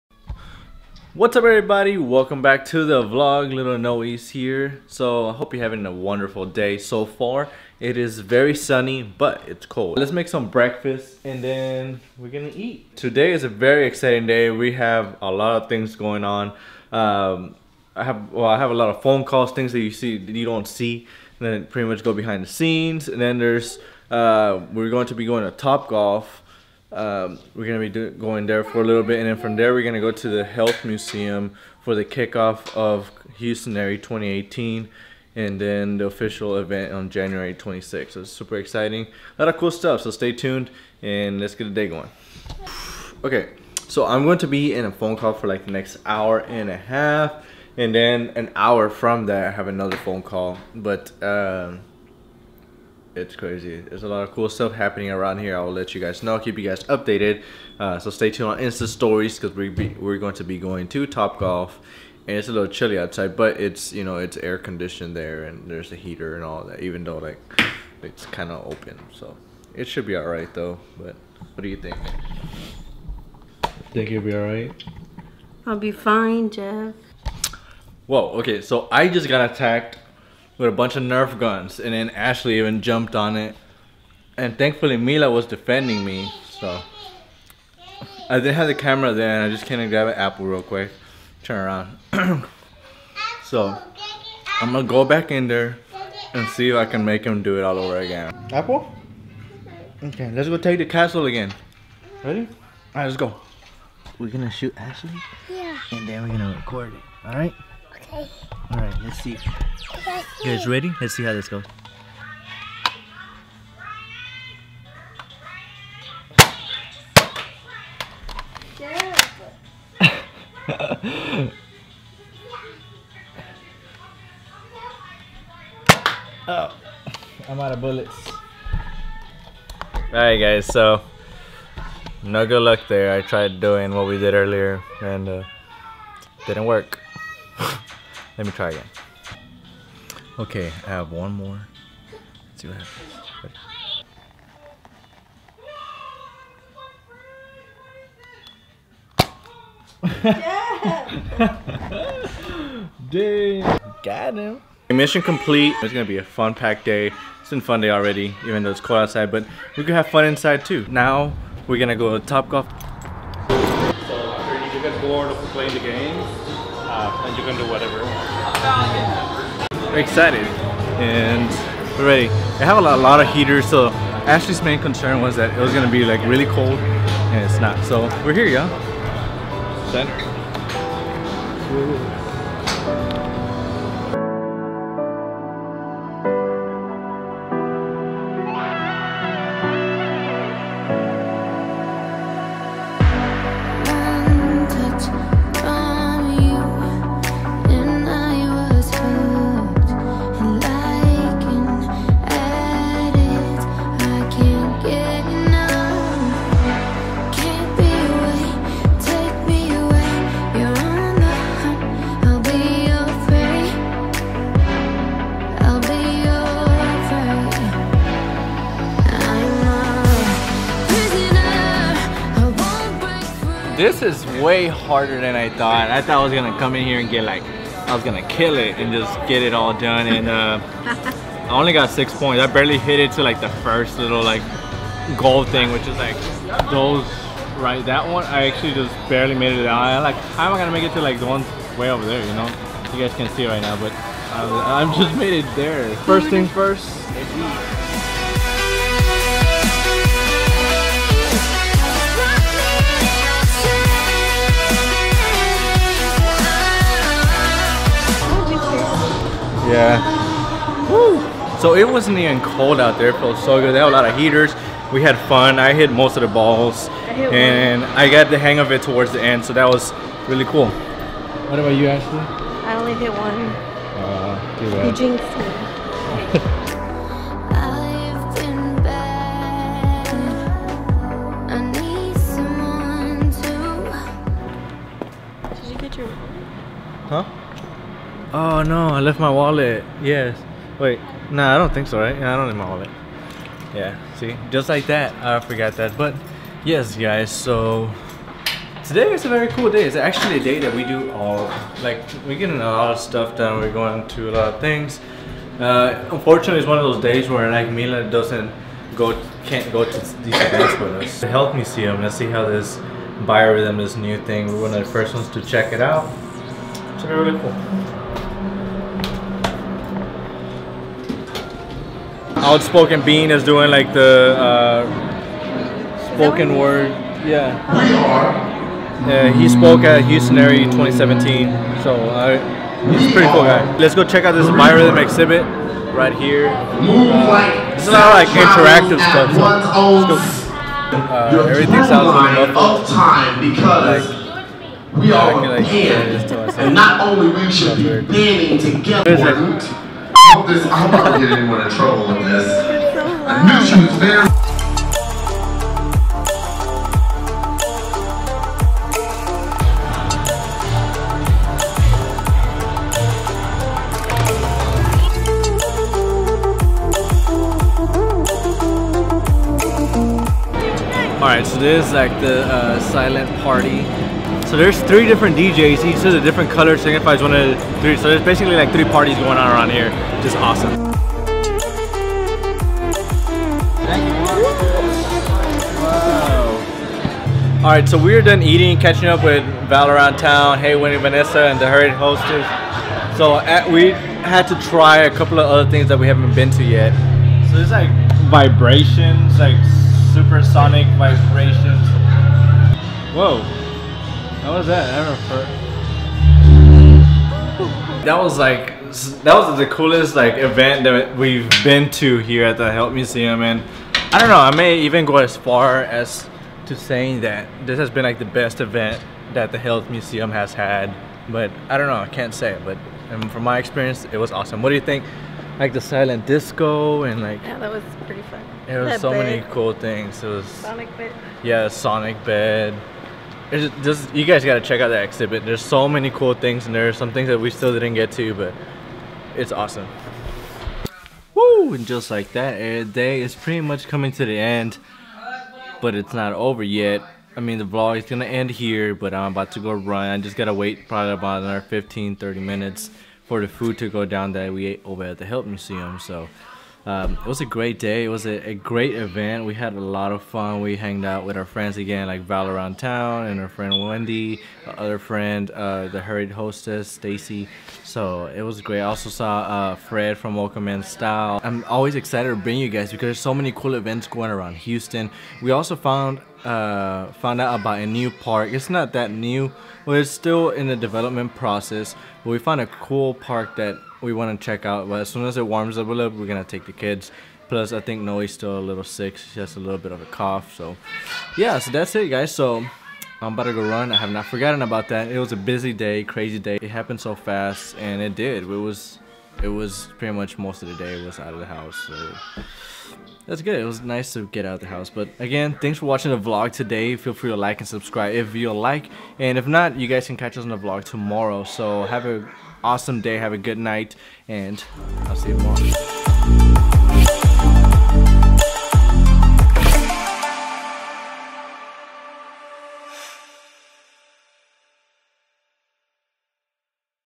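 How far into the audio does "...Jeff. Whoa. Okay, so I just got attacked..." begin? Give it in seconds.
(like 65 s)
76 s.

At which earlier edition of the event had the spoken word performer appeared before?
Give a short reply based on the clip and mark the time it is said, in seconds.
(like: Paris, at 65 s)
Houston Area 2017, at 330 s.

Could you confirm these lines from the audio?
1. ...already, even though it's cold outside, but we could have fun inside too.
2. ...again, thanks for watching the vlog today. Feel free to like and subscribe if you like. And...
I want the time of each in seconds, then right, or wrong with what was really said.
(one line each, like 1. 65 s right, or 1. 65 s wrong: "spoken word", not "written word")
1. 157 s right
2. 505 s right.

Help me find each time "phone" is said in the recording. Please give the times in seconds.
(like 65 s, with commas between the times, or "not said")
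19 s, 44 s, 49 s.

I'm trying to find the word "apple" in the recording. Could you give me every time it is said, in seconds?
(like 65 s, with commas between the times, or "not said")
90 s, 98 s.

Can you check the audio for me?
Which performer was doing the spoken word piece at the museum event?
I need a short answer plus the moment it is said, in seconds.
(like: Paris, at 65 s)
Outspoken Bean, at 322 s.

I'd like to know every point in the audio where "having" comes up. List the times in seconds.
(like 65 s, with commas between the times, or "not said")
5 s.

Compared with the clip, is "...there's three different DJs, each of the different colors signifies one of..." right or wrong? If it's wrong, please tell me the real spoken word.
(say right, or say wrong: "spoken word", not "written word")
right.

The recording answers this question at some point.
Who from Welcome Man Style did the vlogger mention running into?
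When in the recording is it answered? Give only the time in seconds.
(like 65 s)
469 s.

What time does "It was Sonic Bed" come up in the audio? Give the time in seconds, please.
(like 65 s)
430 s.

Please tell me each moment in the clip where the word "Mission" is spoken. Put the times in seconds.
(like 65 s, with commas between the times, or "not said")
154 s.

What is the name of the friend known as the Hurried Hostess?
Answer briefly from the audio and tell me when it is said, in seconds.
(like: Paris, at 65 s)
Stacy, at 466 s.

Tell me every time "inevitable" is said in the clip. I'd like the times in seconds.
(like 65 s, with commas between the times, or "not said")
not said.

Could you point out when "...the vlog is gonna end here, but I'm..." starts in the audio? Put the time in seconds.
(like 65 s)
447 s.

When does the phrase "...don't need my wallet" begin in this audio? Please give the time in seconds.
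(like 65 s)
292 s.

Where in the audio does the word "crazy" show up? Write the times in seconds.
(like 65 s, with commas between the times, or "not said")
53 s, 496 s.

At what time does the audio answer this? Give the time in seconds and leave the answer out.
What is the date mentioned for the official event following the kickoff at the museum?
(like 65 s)
37 s.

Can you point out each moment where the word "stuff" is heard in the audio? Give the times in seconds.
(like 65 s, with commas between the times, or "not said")
39 s, 54 s, 302 s, 338 s.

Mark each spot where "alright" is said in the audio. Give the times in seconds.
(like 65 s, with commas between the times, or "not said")
102 s, 107 s, 130 s, 371 s.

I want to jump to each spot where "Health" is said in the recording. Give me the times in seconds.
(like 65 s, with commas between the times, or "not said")
30 s, 311 s, 412 s, 419 s, 455 s.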